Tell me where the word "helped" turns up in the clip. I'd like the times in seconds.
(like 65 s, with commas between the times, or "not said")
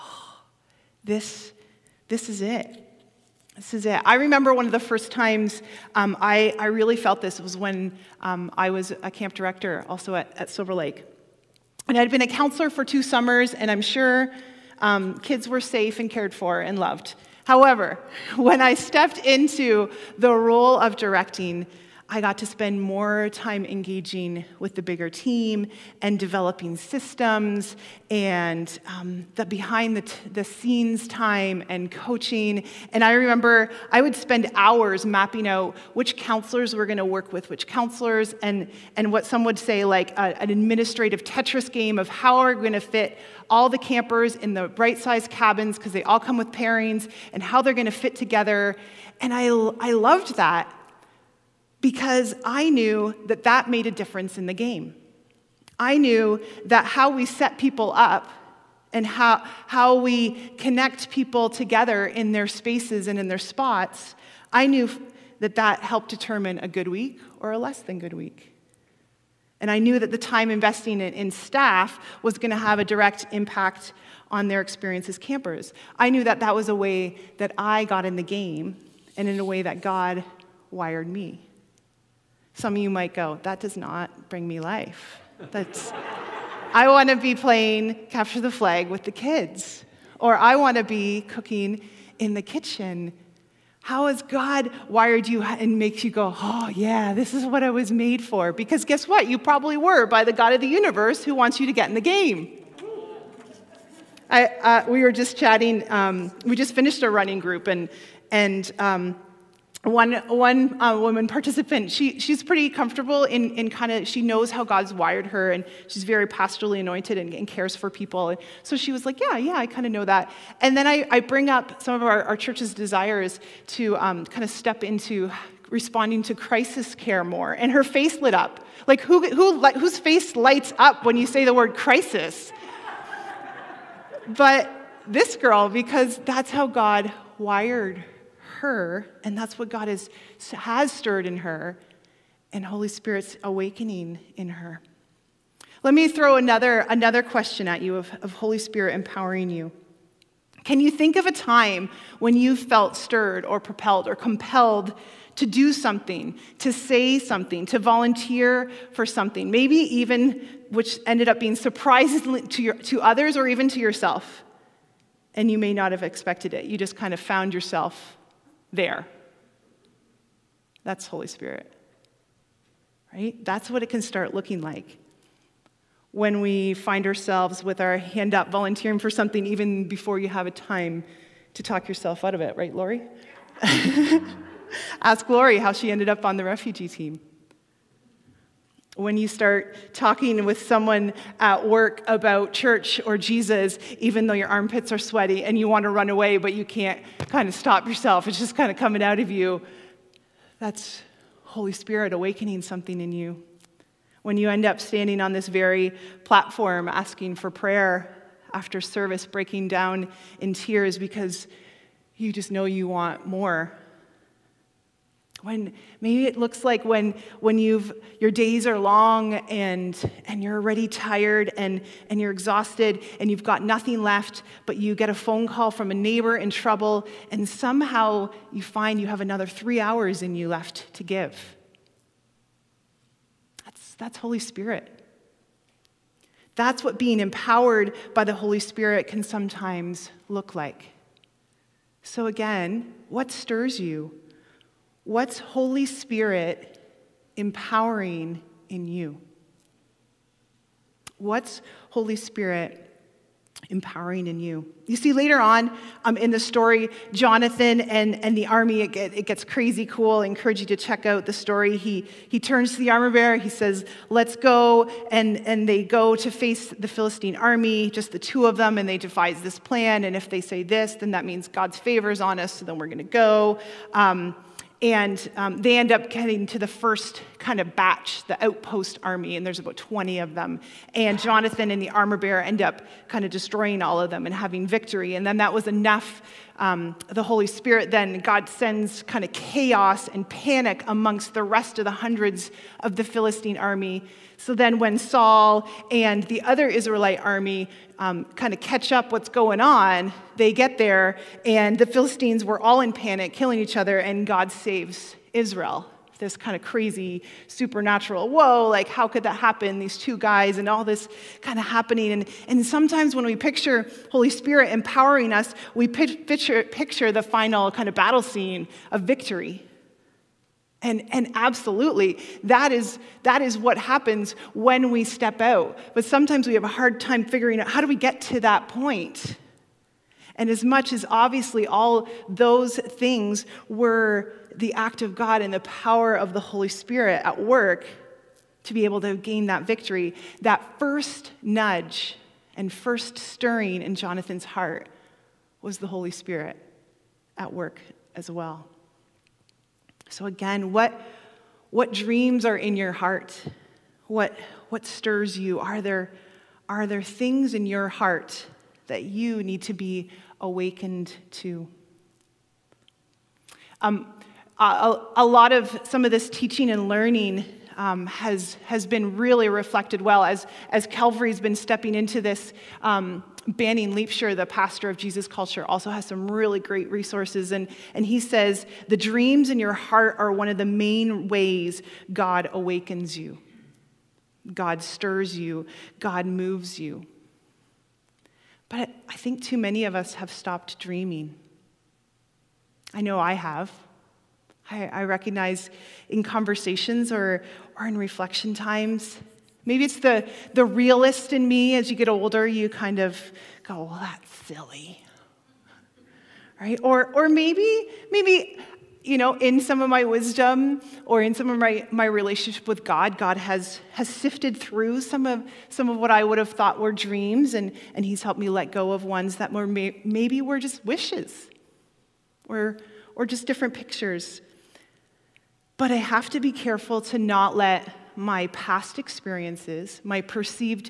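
65 s, 418 s.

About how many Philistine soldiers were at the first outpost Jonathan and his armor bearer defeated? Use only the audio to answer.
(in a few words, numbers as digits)
20.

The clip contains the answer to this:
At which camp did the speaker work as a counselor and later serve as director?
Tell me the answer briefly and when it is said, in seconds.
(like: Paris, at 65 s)
Silver Lake, at 10 s.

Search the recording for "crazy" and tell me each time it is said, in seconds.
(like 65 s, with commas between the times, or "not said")
259 s, 306 s.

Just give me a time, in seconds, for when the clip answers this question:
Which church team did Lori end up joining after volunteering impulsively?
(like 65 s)
186 s.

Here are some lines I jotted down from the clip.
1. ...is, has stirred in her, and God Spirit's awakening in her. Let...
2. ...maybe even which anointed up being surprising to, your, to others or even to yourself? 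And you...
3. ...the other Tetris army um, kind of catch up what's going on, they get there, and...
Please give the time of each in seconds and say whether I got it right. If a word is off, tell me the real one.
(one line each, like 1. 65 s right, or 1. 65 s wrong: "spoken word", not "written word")
1. 139 s wrong: "Holy", not "God"
2. 159 s wrong: "ended", not "anointed"
3. 296 s wrong: "Israelite", not "Tetris".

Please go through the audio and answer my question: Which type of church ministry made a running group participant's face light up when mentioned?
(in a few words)
Crisis care.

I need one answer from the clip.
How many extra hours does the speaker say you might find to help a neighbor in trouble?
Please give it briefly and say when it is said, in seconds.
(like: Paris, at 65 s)
3, at 229 s.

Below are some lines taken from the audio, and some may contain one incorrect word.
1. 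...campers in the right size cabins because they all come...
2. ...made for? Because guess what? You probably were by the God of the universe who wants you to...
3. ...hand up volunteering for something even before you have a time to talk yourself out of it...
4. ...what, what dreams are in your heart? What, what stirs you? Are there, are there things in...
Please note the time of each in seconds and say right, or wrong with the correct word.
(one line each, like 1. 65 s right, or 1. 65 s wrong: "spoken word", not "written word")
1. 43 s right
2. 97 s right
3. 177 s right
4. 350 s right.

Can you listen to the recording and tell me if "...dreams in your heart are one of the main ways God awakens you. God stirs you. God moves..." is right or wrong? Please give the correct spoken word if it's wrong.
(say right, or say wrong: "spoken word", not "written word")
right.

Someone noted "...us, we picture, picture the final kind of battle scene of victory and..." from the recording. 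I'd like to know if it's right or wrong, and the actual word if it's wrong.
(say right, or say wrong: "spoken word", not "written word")
right.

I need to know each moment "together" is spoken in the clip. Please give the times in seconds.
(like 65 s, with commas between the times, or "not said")
48 s, 61 s.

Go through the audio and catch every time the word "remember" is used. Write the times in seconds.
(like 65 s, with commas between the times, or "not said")
4 s, 33 s.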